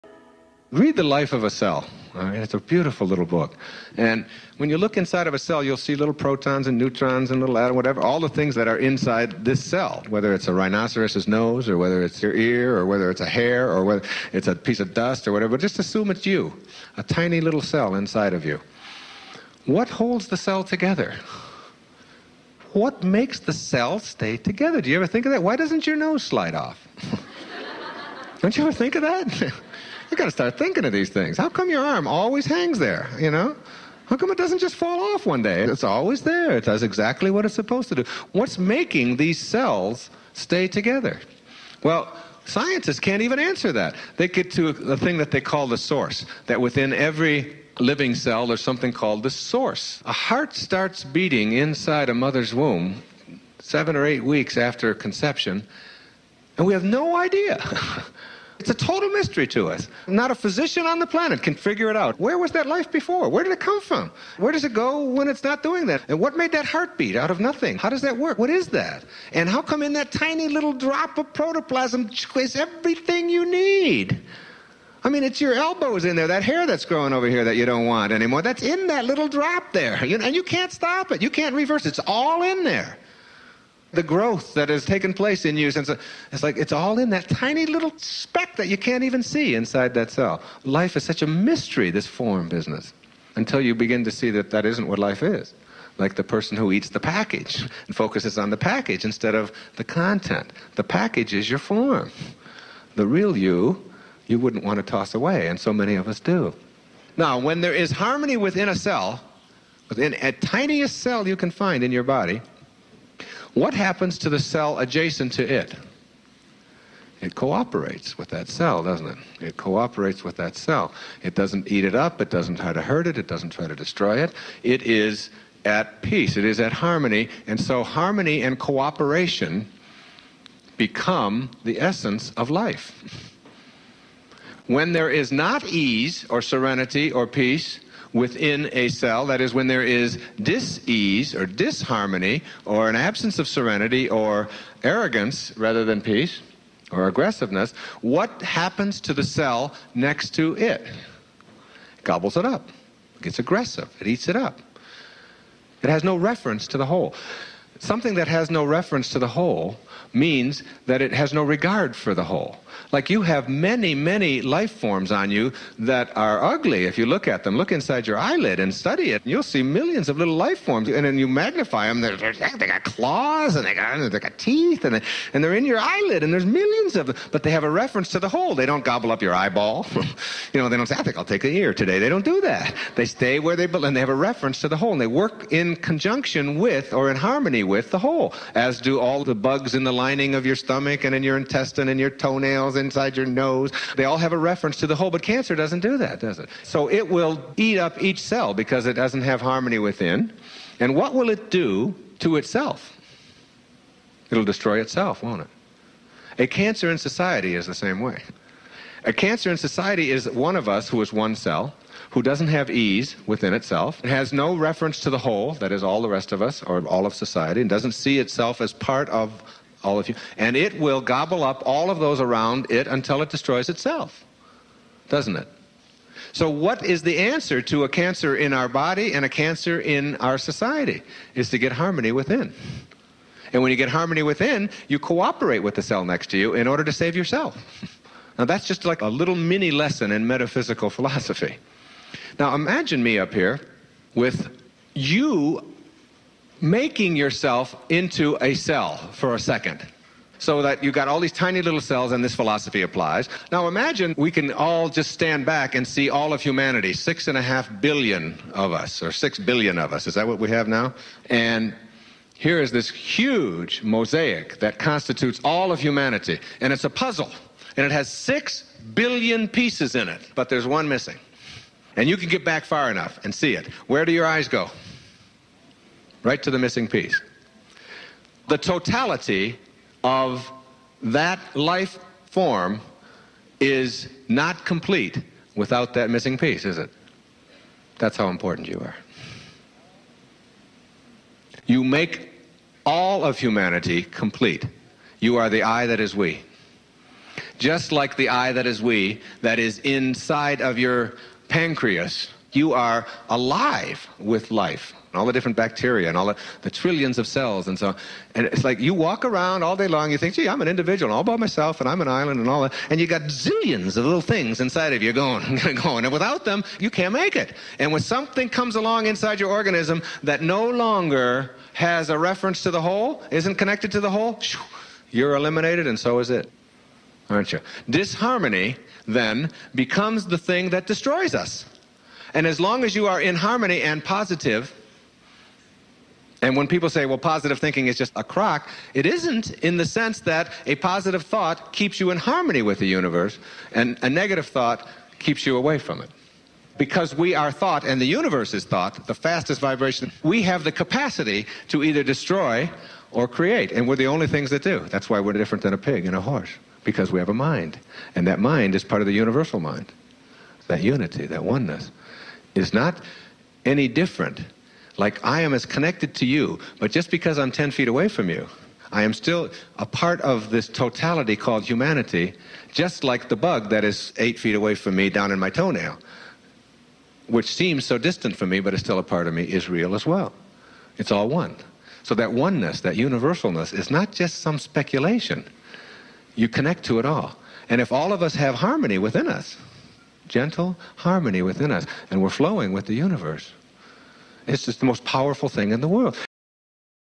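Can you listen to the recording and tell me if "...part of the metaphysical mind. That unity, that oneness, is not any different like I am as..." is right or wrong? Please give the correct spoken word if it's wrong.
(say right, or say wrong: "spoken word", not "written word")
wrong: "universal", not "metaphysical".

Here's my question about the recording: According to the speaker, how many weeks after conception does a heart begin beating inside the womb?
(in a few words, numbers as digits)
7 or 8.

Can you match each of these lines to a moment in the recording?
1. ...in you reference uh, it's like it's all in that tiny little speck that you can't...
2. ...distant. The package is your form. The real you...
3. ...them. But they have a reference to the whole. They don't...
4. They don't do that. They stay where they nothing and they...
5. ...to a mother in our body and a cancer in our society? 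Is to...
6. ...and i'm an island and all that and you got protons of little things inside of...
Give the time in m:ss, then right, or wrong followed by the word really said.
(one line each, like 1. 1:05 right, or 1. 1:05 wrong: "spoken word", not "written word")
1. 1:25 wrong: "since", not "reference"
2. 1:39 wrong: "content", not "distant"
3. 2:57 right
4. 3:01 wrong: "belong", not "nothing"
5. 3:47 wrong: "cancer", not "mother"
6. 5:11 wrong: "zillions", not "protons".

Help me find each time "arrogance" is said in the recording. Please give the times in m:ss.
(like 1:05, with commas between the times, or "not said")
2:24.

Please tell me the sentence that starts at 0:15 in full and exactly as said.
But just assume it's you, a tiny little cell inside of you.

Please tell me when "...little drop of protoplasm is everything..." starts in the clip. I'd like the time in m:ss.
1:10.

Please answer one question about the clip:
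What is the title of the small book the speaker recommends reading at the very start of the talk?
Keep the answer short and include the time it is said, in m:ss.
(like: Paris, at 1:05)
The Life of a Cell, at 0:00.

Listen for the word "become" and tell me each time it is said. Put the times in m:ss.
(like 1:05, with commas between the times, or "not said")
2:10, 5:29.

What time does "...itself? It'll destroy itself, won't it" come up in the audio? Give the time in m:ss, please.
3:22.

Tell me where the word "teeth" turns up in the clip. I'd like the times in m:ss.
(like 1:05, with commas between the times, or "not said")
2:54.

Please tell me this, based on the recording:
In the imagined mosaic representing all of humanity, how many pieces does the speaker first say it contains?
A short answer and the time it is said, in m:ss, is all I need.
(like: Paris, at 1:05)
6.5 billion, at 4:16.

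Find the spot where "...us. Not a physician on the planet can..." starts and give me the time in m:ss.
0:59.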